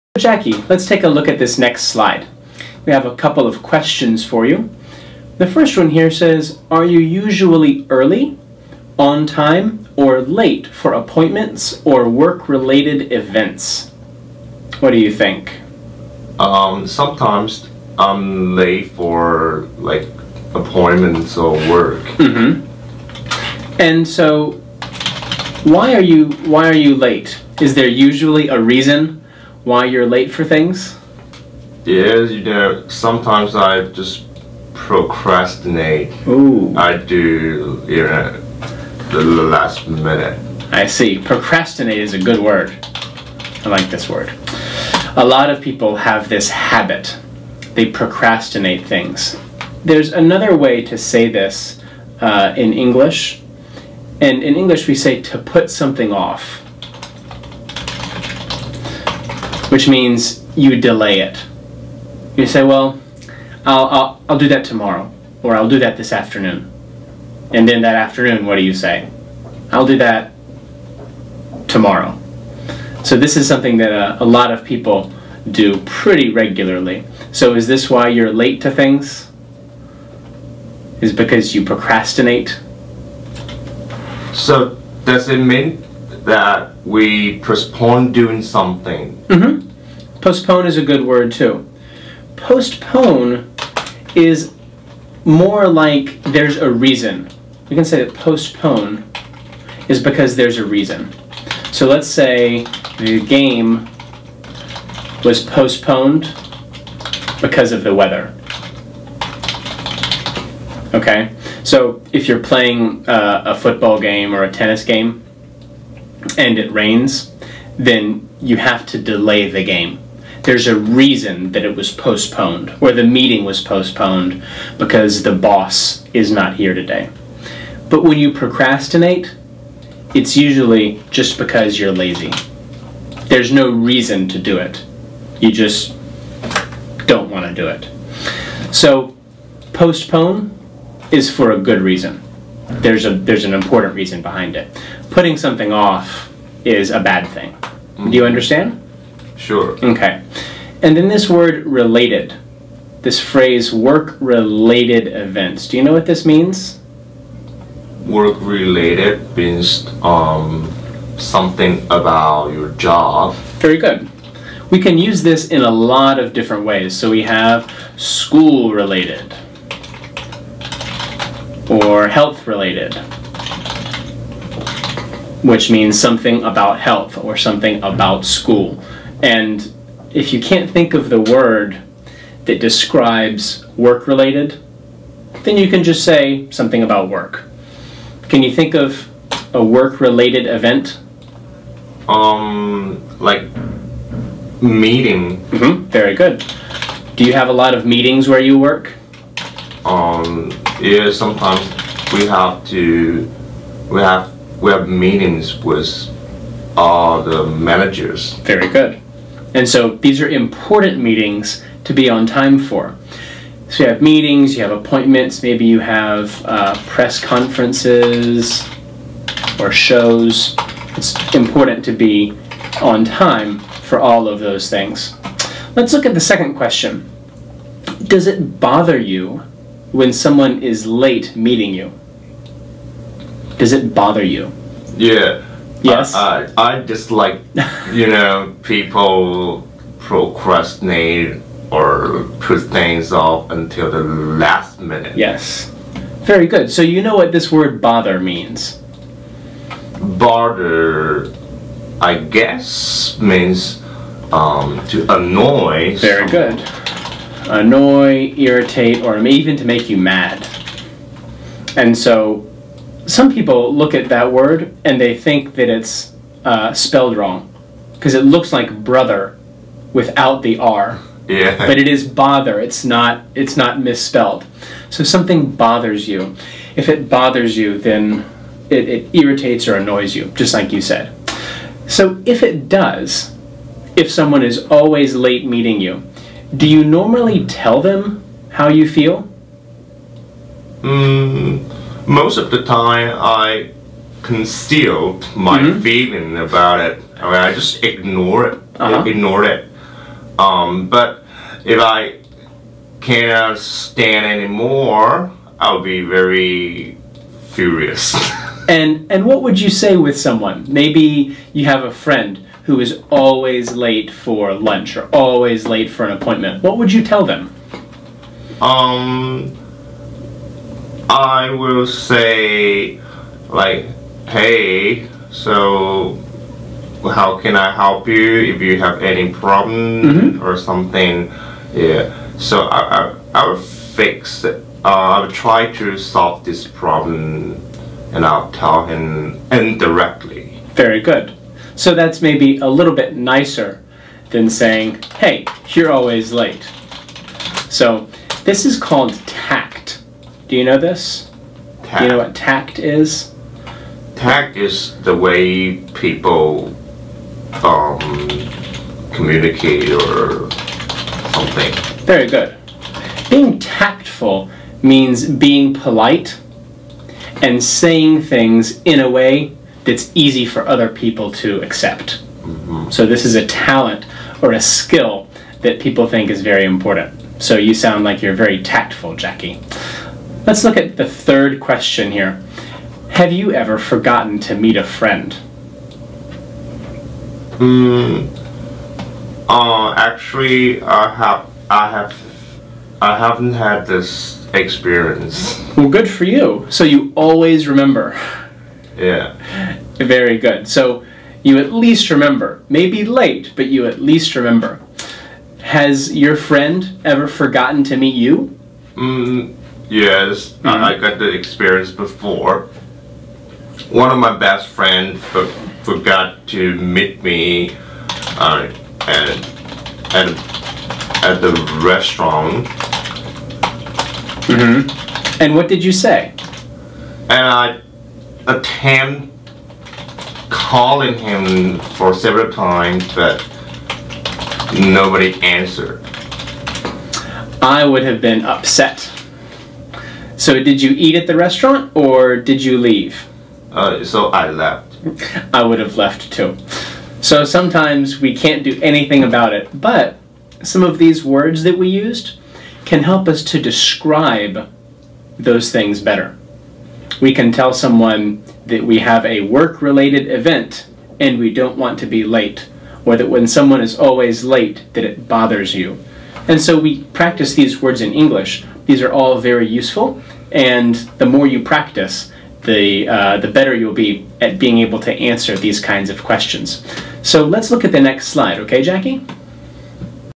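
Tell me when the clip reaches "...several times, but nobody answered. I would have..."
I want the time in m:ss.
7:12.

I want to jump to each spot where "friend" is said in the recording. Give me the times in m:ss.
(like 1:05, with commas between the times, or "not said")
5:11, 6:24, 6:46, 6:54.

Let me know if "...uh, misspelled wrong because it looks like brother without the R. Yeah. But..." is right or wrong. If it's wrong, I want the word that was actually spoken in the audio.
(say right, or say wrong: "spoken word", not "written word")
wrong: "spelled", not "misspelled".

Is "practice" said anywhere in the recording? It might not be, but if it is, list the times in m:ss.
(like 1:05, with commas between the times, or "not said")
7:47, 7:51.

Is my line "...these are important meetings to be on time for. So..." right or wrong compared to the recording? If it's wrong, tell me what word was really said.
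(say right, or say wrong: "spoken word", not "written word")
right.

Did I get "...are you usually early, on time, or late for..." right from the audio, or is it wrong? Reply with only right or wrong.
right.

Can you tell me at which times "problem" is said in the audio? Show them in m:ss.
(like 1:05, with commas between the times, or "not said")
5:29, 5:36.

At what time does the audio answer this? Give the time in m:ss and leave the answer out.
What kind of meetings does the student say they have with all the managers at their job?
3:24.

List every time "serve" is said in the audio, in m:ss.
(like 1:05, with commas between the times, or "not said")
not said.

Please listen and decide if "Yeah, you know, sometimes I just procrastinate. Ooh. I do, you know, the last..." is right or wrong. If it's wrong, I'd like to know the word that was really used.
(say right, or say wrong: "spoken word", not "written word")
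right.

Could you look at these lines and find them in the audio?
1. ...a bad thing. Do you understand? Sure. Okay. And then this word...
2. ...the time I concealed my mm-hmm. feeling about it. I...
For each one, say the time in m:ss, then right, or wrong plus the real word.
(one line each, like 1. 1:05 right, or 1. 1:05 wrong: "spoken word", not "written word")
1. 2:26 right
2. 4:52 right.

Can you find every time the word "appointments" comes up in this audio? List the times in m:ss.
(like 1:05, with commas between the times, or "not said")
0:10, 0:20, 3:34, 5:16.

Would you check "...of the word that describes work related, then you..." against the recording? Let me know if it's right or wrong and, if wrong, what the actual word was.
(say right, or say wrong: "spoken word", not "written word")
right.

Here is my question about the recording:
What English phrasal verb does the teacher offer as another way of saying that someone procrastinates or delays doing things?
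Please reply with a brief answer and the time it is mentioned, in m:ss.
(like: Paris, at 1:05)
put something off, at 0:55.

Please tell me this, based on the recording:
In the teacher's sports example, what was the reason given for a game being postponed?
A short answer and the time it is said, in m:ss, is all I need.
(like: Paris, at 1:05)
the weather, at 1:47.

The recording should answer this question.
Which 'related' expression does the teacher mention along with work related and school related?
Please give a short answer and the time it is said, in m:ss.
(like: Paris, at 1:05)
health related, at 2:52.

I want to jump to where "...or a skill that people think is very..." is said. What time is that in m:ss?
6:14.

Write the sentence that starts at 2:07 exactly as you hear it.
But when you procrastinate, it's usually just because you're lazy.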